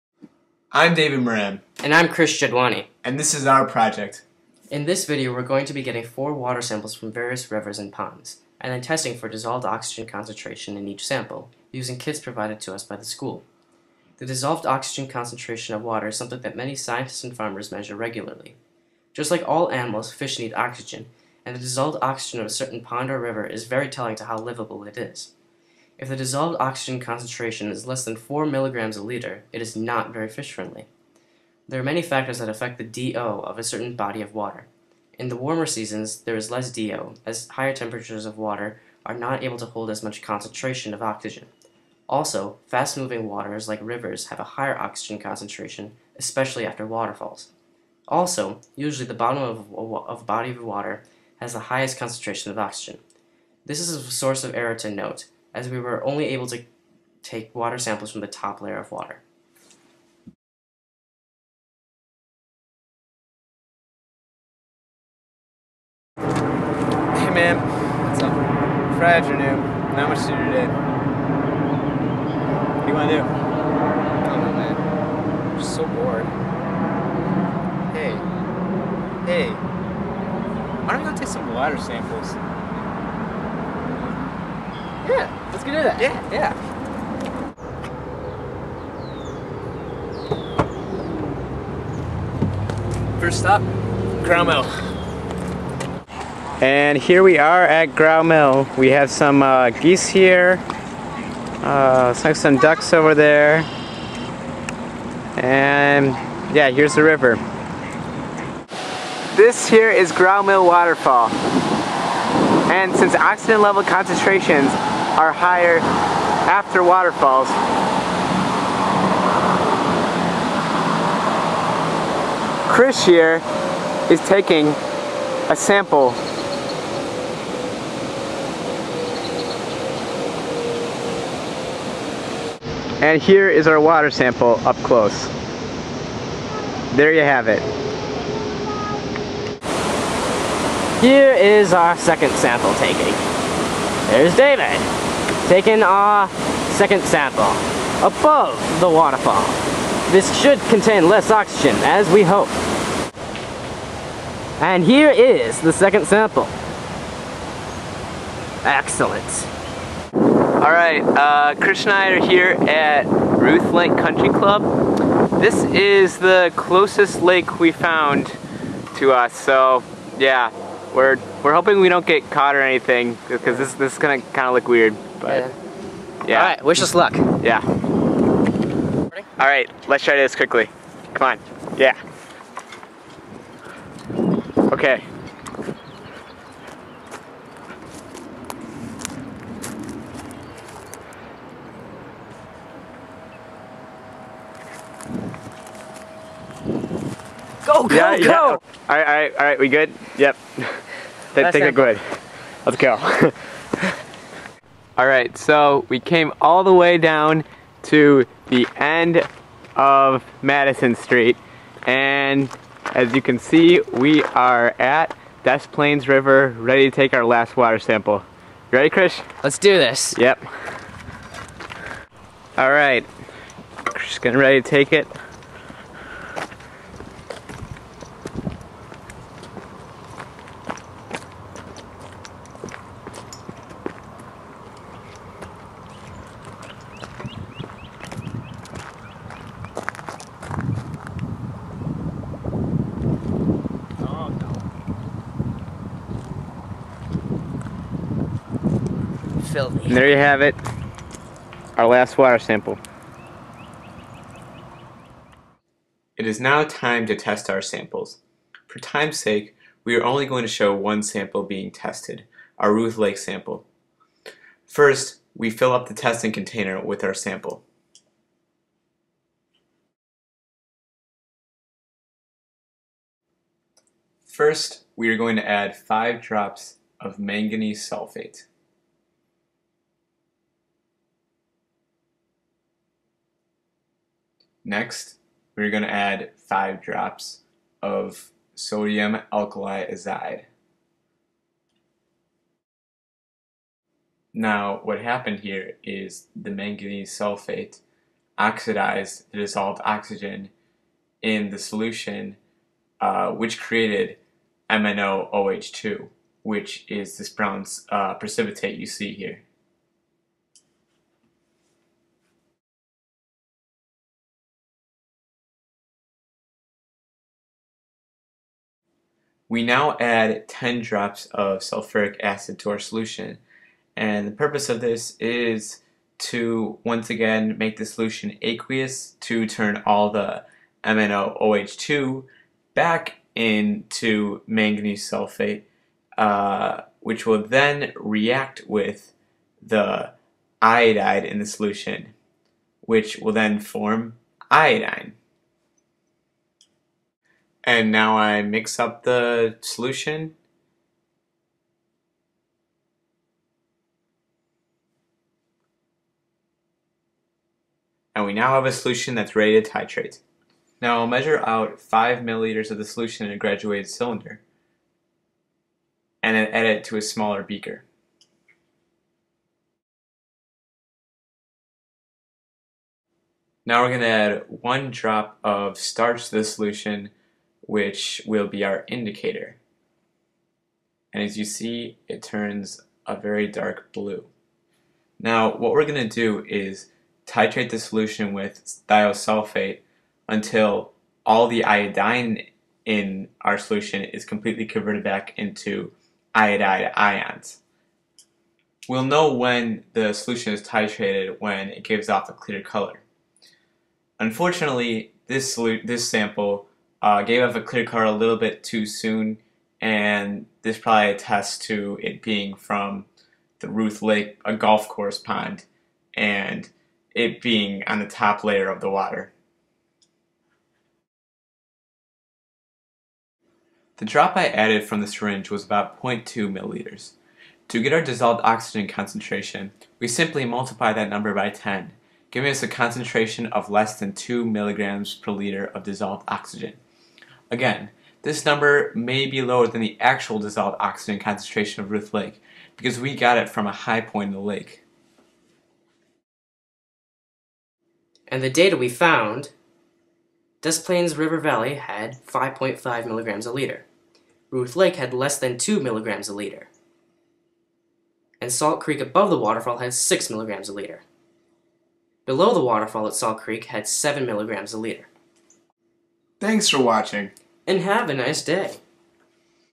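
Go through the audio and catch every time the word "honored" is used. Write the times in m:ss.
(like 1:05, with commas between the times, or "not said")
not said.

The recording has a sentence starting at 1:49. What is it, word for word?
This here is Graue Mill Waterfall.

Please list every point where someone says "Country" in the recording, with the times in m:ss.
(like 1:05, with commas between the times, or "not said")
2:43.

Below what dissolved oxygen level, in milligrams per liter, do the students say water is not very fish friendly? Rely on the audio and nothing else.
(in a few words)
4 milligrams a liter.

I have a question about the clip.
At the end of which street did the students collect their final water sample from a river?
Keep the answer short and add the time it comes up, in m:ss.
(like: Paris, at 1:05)
Madison Street, at 3:30.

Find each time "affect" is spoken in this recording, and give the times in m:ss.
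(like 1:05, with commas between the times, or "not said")
0:32.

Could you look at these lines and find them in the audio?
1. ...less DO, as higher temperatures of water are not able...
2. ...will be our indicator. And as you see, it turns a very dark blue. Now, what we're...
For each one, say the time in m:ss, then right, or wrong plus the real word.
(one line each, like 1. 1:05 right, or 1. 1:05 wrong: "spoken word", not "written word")
1. 0:36 right
2. 6:18 right.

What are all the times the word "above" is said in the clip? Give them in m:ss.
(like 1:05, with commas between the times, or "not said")
2:28, 7:39.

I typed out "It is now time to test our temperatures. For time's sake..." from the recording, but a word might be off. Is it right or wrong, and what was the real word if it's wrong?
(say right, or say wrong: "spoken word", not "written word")
wrong: "samples", not "temperatures".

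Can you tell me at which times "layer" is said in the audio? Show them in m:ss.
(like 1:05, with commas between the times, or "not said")
0:58, 6:58.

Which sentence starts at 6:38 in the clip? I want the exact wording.
We'll know when the solution is titrated when it gives off a clear color.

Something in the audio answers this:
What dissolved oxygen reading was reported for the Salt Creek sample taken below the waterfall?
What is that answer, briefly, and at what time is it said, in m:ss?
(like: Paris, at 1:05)
7 milligrams a liter, at 7:43.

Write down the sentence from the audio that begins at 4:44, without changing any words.
Next, we're going to add 5 drops of sodium alkali azide.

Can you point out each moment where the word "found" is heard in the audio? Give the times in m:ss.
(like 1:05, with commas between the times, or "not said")
2:47, 7:28.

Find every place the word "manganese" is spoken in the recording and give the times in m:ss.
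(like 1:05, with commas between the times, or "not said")
4:37, 4:56, 5:34.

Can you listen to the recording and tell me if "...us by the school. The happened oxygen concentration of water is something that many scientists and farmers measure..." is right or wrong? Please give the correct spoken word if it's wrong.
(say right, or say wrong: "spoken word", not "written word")
wrong: "dissolved", not "happened".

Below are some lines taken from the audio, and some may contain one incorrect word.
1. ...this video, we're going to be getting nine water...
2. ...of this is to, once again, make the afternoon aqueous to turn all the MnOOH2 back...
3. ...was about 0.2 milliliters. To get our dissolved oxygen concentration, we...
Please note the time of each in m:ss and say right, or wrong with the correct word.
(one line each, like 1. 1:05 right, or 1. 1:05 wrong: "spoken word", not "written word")
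1. 0:04 wrong: "four", not "nine"
2. 5:24 wrong: "solution", not "afternoon"
3. 7:05 right.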